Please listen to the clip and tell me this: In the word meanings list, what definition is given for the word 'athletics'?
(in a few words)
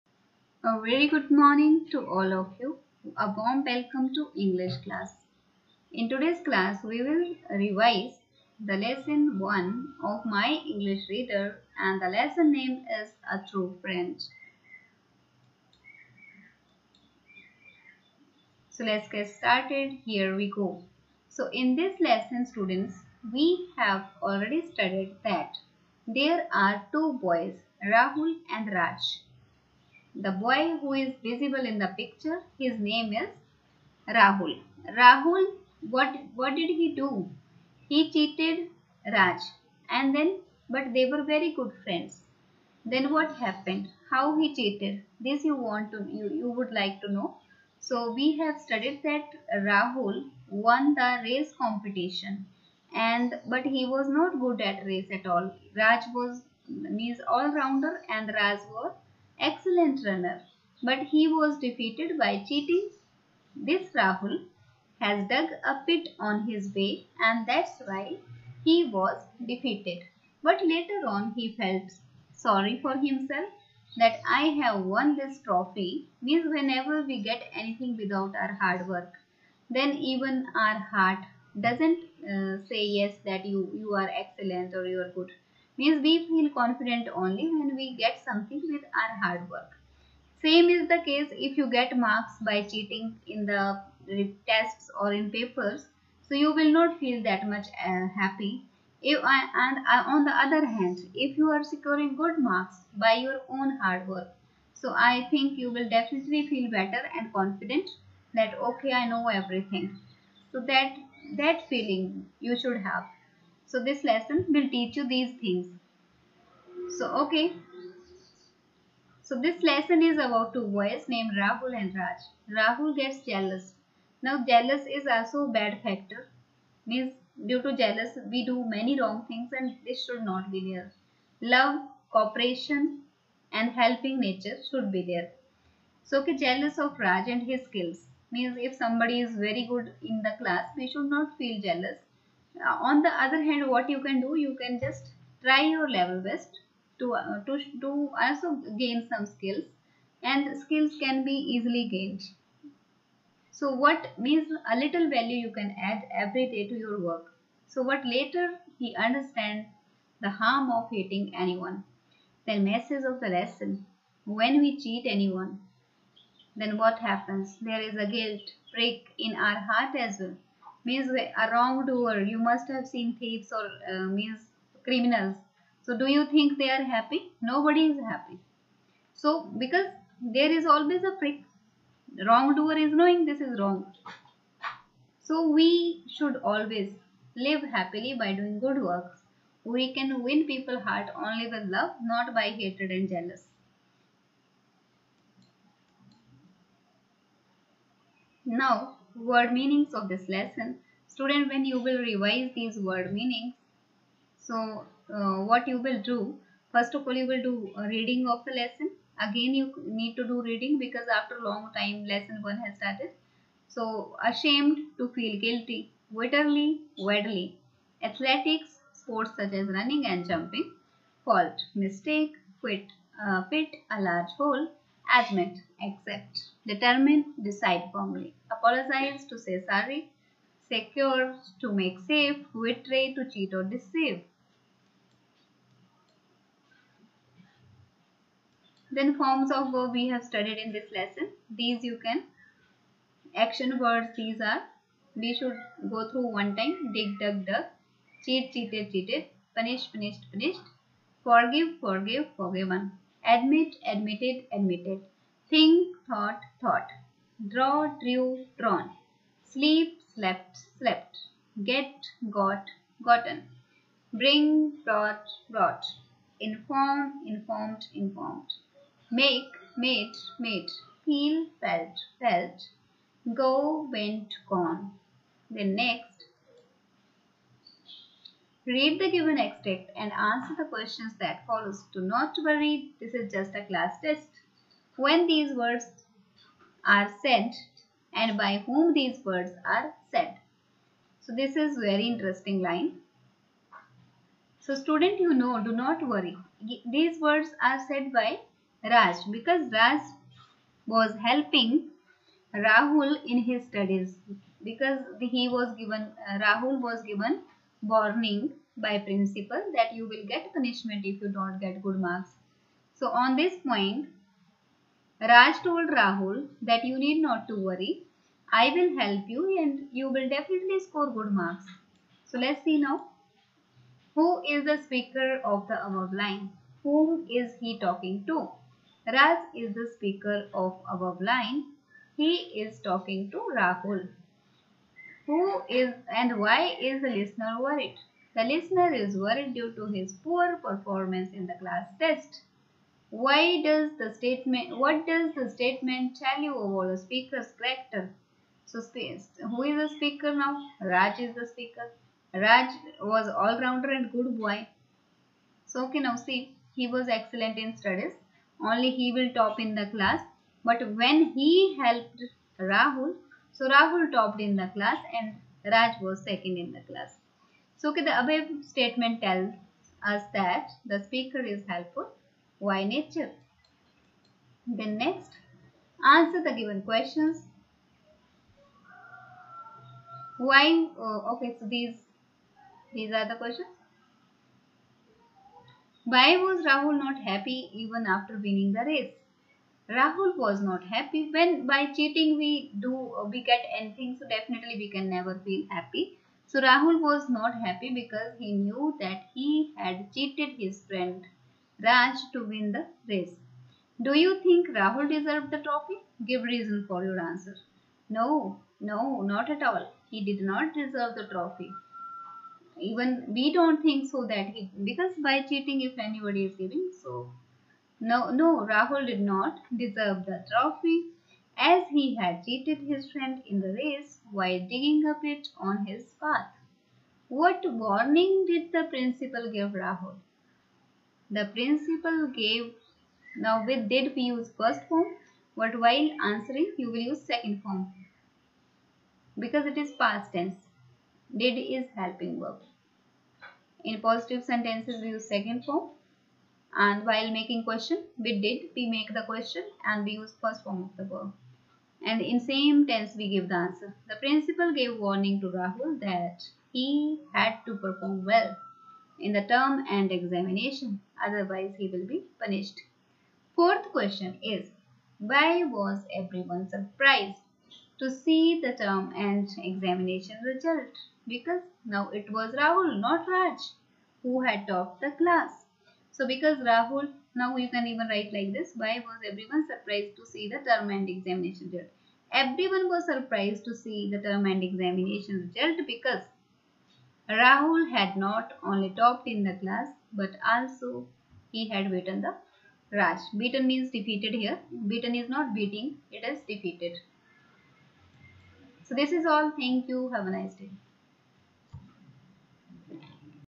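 Sports such as running and jumping.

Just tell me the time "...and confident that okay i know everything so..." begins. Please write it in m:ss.
1:47.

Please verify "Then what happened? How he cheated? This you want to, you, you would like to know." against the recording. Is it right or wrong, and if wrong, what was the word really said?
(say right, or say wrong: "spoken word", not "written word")
right.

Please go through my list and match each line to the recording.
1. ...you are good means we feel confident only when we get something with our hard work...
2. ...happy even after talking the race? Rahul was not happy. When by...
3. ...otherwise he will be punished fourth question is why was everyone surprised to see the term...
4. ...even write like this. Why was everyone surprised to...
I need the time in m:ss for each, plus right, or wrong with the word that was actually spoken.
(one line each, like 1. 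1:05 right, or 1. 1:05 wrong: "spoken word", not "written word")
1. 1:24 right
2. 6:27 wrong: "winning", not "talking"
3. 7:41 right
4. 7:57 right.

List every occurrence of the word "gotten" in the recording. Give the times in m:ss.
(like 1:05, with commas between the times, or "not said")
4:23.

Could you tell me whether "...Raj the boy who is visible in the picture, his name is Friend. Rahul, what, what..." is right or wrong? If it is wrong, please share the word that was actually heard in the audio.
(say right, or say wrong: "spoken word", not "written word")
wrong: "Rahul", not "Friend".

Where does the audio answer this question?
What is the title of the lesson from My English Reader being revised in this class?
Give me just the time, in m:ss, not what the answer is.
0:13.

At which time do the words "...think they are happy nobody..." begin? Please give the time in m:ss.
2:56.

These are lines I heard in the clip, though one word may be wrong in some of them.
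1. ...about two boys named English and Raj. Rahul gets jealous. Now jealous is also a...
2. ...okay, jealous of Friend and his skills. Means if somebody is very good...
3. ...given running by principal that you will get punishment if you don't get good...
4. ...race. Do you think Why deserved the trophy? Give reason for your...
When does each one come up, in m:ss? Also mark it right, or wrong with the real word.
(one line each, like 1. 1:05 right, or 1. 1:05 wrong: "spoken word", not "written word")
1. 2:00 wrong: "Rahul", not "English"
2. 2:16 wrong: "Raj", not "Friend"
3. 5:07 wrong: "warning", not "running"
4. 6:43 wrong: "Rahul", not "Why".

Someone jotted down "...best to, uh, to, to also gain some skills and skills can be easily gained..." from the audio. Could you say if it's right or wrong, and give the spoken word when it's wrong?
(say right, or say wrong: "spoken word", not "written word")
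right.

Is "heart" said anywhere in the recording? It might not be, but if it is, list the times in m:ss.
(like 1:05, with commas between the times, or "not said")
1:20, 2:49, 3:10.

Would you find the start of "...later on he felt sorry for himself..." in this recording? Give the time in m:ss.
1:10.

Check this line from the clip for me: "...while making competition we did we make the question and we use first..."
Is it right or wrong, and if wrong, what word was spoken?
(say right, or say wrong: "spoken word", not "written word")
wrong: "question", not "competition".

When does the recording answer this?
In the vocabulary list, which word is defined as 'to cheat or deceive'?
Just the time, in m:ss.
3:52.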